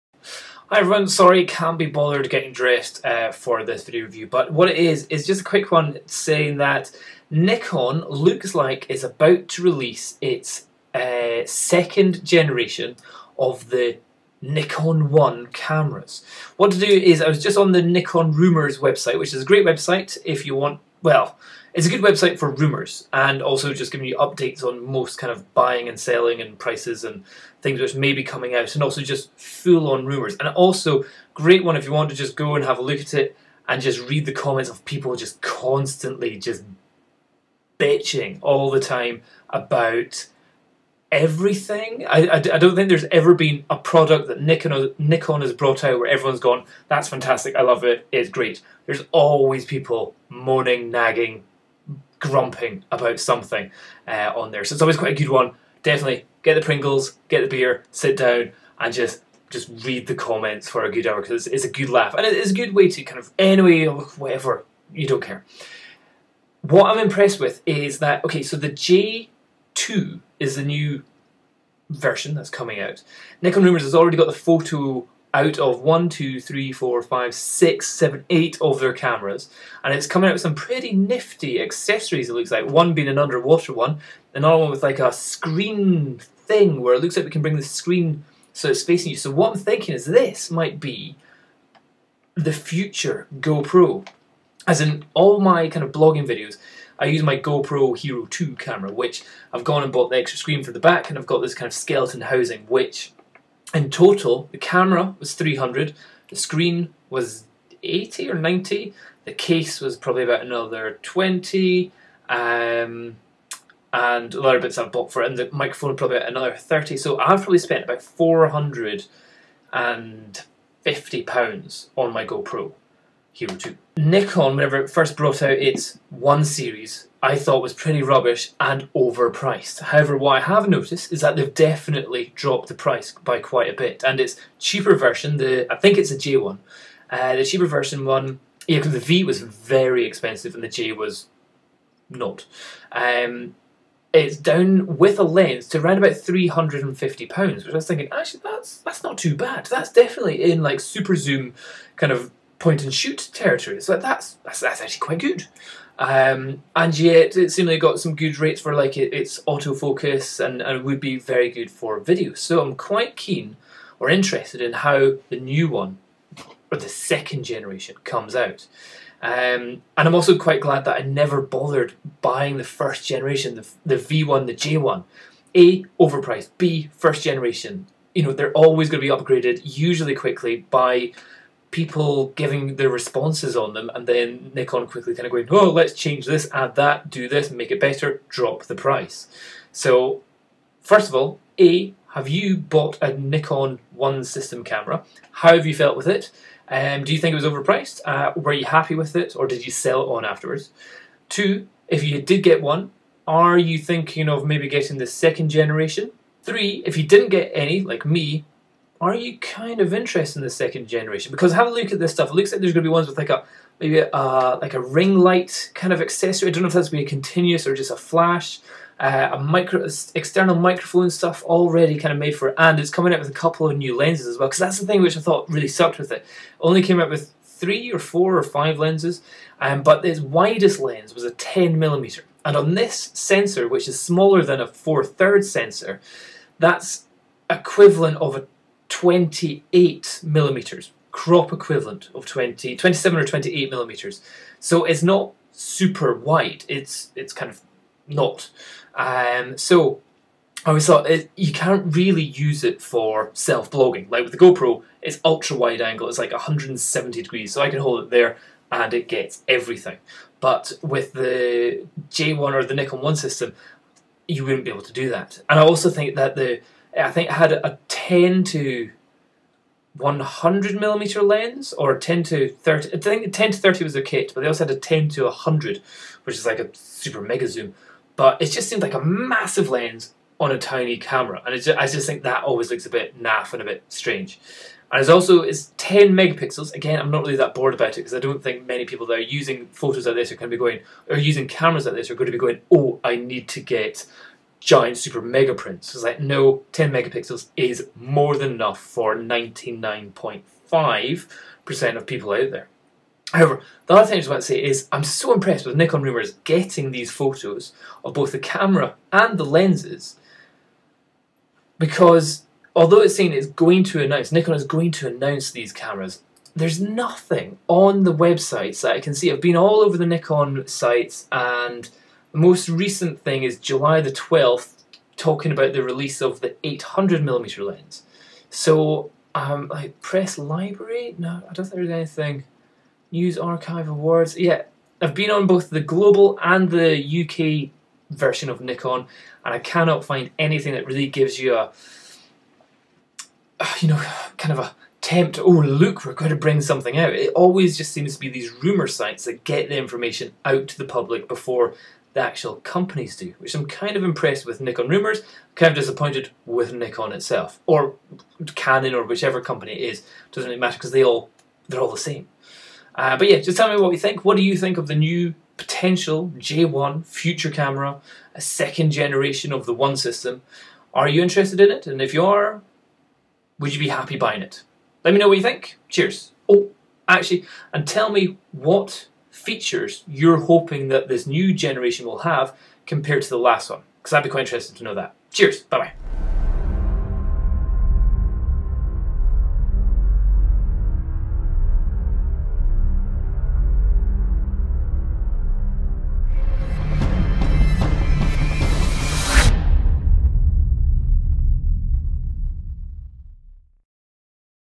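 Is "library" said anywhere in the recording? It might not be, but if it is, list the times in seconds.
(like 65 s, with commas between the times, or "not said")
330 s.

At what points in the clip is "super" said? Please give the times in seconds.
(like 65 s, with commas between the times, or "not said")
150 s, 245 s, 276 s, 294 s.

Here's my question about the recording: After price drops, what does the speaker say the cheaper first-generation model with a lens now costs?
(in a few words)
350 pounds.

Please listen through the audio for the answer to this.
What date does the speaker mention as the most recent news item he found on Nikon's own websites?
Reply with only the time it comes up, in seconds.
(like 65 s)
323 s.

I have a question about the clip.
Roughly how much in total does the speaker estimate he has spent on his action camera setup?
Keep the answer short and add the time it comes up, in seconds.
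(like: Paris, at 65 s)
450 pounds, at 118 s.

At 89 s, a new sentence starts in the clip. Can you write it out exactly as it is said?
So what I'm thinking is this might be the future GoPro.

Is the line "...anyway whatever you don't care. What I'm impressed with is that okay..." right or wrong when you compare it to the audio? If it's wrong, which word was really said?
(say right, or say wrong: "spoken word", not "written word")
right.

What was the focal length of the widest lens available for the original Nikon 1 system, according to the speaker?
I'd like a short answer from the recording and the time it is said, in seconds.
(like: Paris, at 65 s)
10 millimeter, at 231 s.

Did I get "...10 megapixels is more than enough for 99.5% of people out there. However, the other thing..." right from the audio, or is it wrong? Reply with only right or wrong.
right.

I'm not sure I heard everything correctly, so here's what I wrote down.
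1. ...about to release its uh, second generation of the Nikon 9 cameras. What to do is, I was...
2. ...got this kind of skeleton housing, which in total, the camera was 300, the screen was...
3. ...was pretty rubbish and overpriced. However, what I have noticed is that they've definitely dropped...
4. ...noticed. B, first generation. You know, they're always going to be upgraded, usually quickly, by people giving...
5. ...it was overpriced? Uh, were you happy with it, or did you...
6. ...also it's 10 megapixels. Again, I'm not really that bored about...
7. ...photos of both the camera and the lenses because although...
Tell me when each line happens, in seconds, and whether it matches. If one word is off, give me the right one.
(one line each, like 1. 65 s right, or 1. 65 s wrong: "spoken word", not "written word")
1. 9 s wrong: "1", not "9"
2. 101 s right
3. 127 s right
4. 176 s wrong: "overpriced", not "noticed"
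5. 197 s right
6. 285 s right
7. 307 s right.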